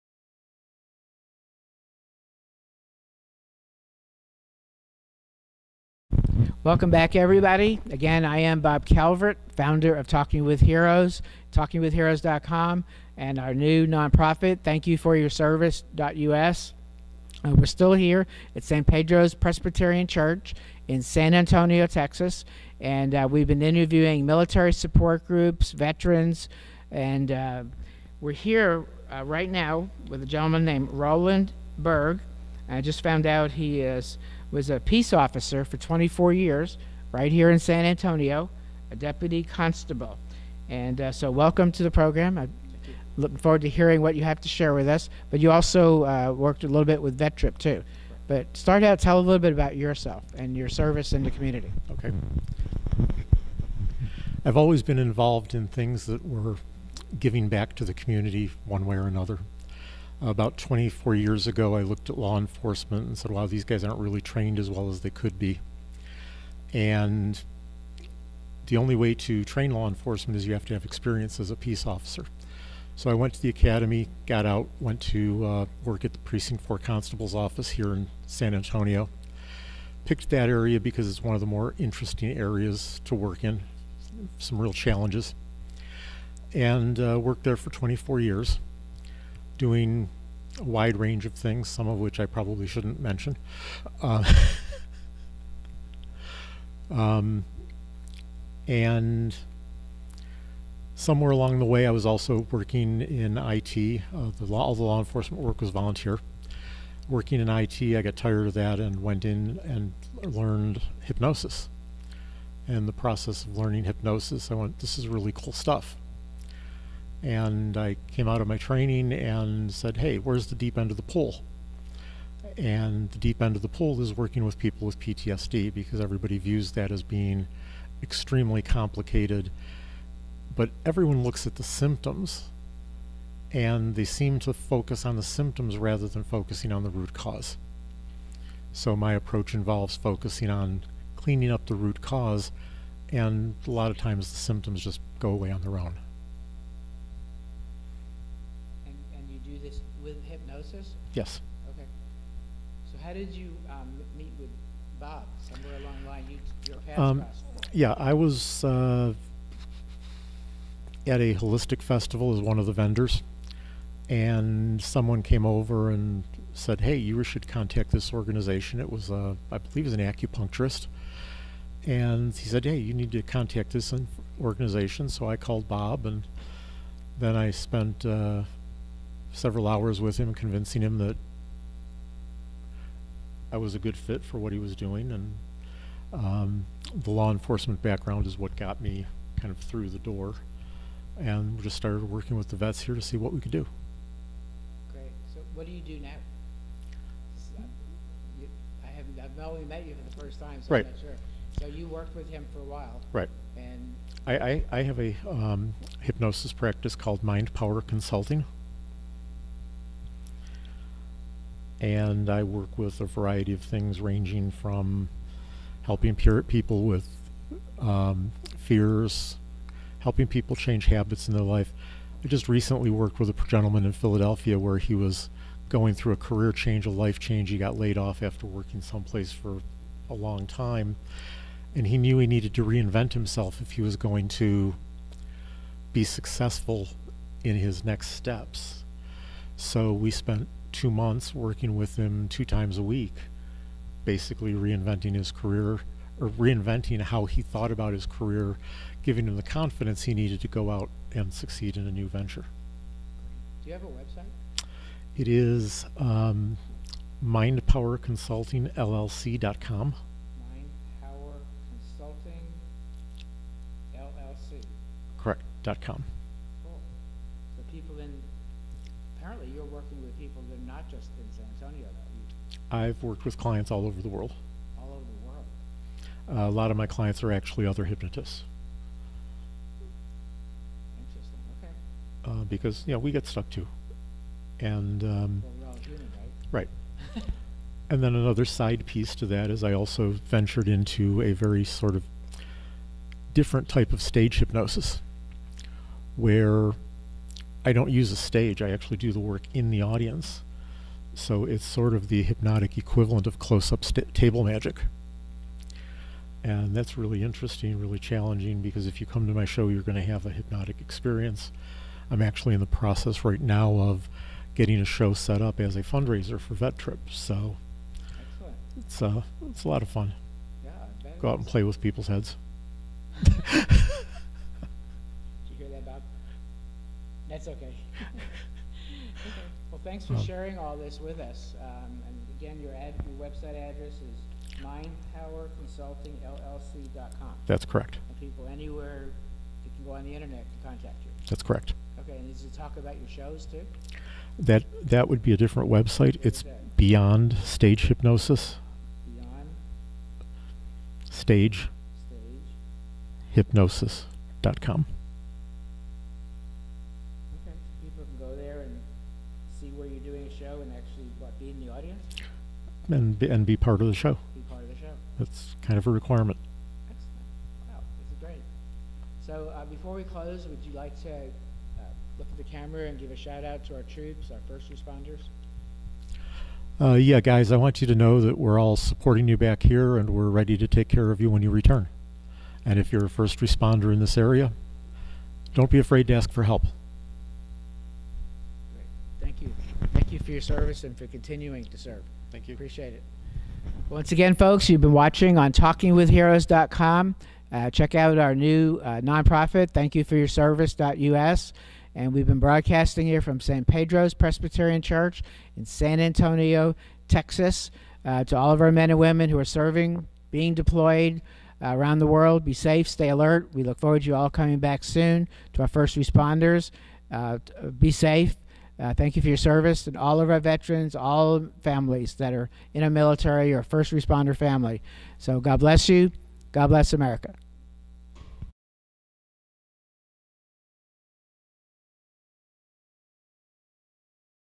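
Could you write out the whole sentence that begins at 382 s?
And if you're a first responder in this area, don't be afraid to ask for help.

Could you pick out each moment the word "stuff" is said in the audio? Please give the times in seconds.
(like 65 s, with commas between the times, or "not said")
115 s.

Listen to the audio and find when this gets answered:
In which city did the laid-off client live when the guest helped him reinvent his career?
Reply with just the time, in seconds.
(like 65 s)
223 s.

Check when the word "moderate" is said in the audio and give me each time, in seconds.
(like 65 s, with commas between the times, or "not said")
not said.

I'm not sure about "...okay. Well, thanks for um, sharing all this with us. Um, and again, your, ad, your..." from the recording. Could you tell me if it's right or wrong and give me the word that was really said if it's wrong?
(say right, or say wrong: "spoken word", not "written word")
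right.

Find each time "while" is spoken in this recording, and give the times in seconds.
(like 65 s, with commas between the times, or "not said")
202 s.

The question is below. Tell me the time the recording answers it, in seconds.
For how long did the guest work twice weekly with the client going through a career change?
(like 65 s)
240 s.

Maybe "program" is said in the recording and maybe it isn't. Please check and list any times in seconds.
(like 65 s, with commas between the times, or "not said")
41 s.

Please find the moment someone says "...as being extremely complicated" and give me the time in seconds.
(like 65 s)
126 s.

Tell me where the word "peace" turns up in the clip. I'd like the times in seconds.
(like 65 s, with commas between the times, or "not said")
34 s, 71 s.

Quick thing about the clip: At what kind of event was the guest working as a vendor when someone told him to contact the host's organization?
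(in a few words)
Holistic festival.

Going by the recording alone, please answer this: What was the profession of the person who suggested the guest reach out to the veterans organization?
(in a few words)
Acupuncturist.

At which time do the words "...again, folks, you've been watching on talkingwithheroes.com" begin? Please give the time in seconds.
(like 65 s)
394 s.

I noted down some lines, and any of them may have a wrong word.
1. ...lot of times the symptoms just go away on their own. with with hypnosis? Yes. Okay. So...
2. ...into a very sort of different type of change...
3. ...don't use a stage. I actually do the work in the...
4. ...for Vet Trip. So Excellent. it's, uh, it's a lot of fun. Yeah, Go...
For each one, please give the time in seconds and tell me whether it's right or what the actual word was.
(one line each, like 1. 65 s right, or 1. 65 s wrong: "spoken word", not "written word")
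1. 143 s right
2. 290 s wrong: "stage", not "change"
3. 297 s right
4. 316 s right.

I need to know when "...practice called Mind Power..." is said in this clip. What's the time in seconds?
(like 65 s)
206 s.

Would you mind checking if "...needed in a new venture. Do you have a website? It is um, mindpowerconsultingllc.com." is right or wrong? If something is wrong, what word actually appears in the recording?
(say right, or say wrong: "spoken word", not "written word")
wrong: "succeed", not "needed".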